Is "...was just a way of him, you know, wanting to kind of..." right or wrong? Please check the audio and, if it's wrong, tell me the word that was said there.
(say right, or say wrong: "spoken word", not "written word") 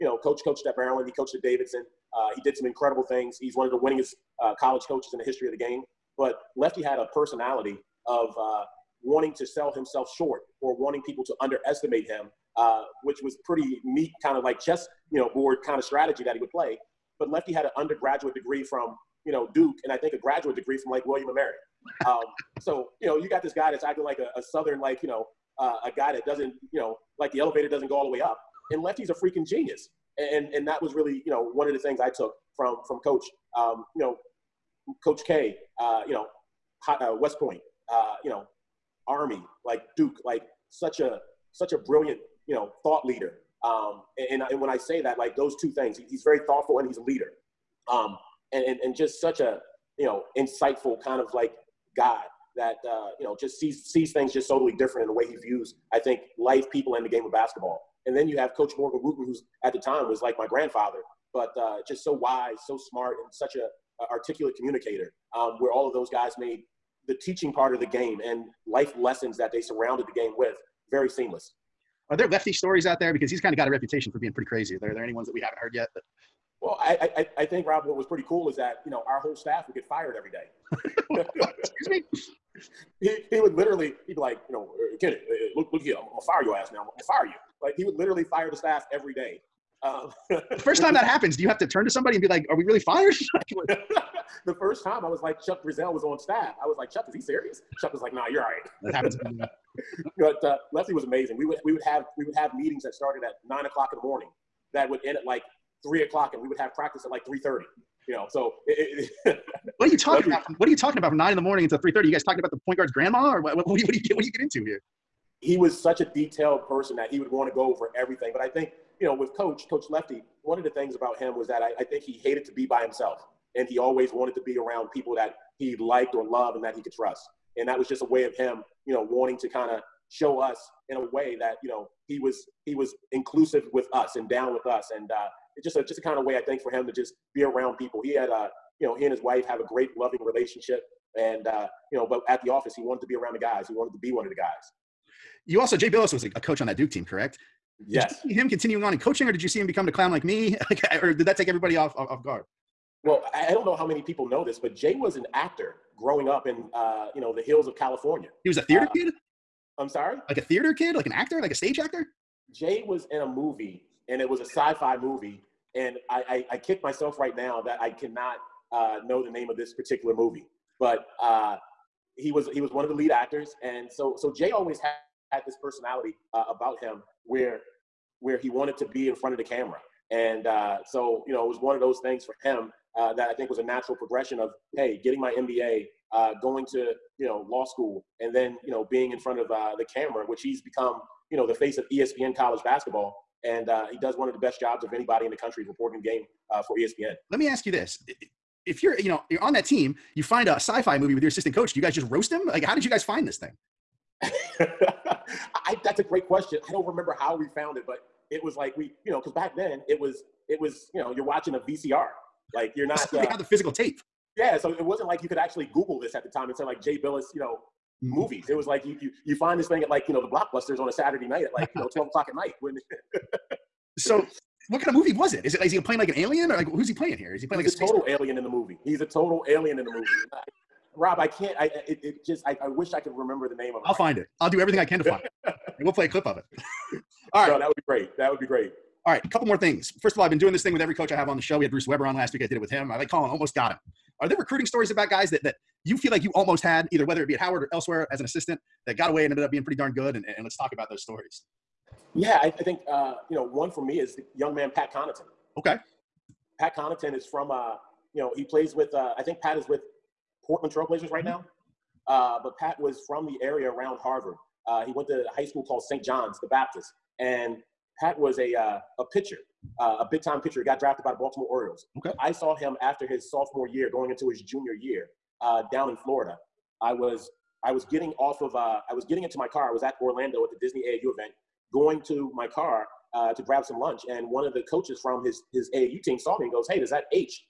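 right.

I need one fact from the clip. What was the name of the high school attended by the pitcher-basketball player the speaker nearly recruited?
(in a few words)
St. John's the Baptist.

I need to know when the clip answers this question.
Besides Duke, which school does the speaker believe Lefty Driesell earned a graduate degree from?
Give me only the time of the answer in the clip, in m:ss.
0:21.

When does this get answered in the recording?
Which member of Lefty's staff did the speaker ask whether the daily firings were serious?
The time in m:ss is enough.
1:35.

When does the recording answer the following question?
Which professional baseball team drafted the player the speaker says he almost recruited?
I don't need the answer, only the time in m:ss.
4:31.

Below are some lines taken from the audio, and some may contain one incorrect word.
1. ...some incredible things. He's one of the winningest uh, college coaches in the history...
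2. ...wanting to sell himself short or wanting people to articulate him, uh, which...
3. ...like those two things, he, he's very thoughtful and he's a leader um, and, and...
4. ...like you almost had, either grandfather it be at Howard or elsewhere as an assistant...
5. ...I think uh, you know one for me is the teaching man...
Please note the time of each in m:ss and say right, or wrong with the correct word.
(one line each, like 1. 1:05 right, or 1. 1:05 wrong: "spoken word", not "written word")
1. 0:02 right
2. 0:09 wrong: "underestimate", not "articulate"
3. 0:45 right
4. 4:06 wrong: "whether", not "grandfather"
5. 4:12 wrong: "young", not "teaching".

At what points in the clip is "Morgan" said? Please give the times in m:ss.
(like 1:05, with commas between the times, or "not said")
0:58.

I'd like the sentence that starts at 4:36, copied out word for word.
I was I was getting off of uh, I was getting into my car.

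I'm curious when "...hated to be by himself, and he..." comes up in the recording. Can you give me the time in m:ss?
2:02.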